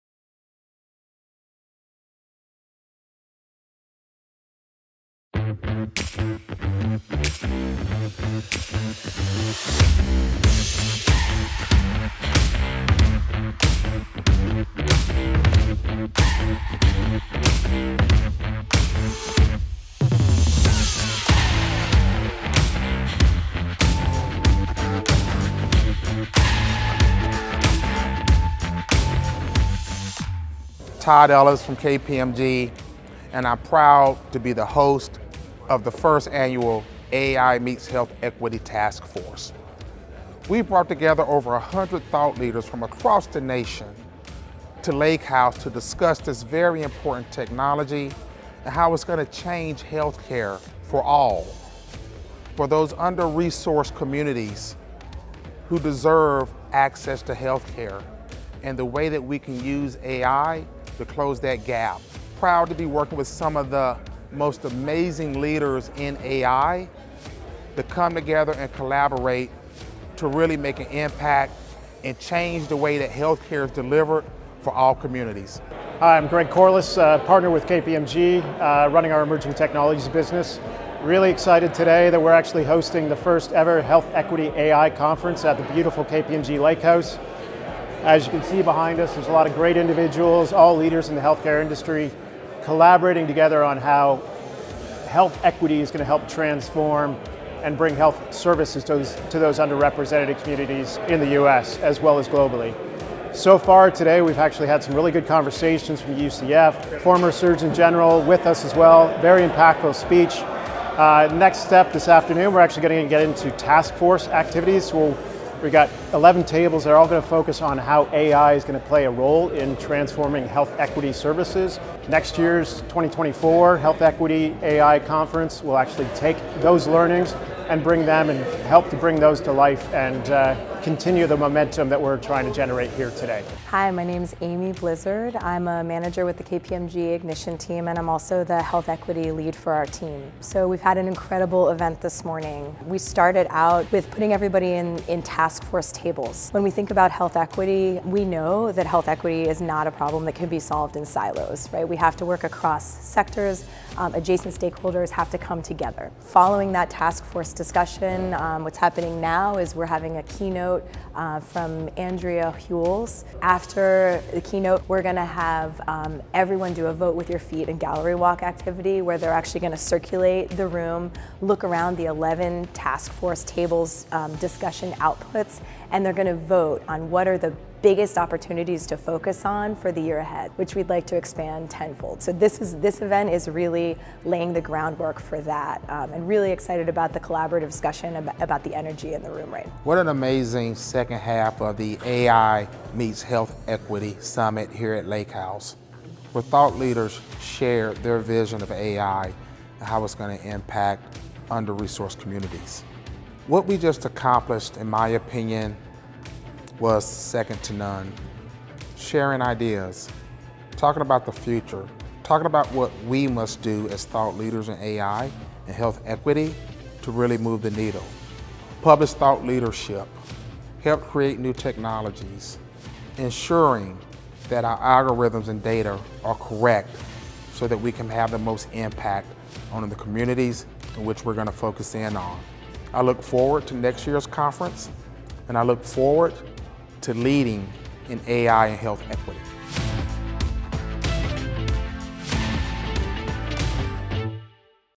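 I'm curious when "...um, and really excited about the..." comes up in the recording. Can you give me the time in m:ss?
3:05.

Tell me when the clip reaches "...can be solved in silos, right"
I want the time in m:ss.
2:30.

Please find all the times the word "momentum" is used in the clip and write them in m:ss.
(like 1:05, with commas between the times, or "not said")
2:11.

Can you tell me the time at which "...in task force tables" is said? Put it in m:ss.
2:25.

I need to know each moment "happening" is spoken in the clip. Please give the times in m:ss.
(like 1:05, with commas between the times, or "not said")
2:38.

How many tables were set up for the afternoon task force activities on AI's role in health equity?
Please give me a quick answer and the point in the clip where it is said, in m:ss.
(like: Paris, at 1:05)
11, at 1:56.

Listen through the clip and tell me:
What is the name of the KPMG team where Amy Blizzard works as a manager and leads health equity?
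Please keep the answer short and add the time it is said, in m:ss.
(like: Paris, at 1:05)
Ignition, at 2:16.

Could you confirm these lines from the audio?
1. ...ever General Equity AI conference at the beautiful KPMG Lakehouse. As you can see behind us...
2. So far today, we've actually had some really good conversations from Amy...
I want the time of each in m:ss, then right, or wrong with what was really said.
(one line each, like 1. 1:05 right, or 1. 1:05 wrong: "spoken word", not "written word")
1. 1:23 wrong: "Health", not "General"
2. 1:43 wrong: "UCF", not "Amy".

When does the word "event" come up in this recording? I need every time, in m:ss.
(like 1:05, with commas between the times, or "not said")
2:21, 3:03.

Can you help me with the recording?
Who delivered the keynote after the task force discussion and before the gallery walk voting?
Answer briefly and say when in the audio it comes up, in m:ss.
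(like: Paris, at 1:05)
Andrea Hules, at 2:41.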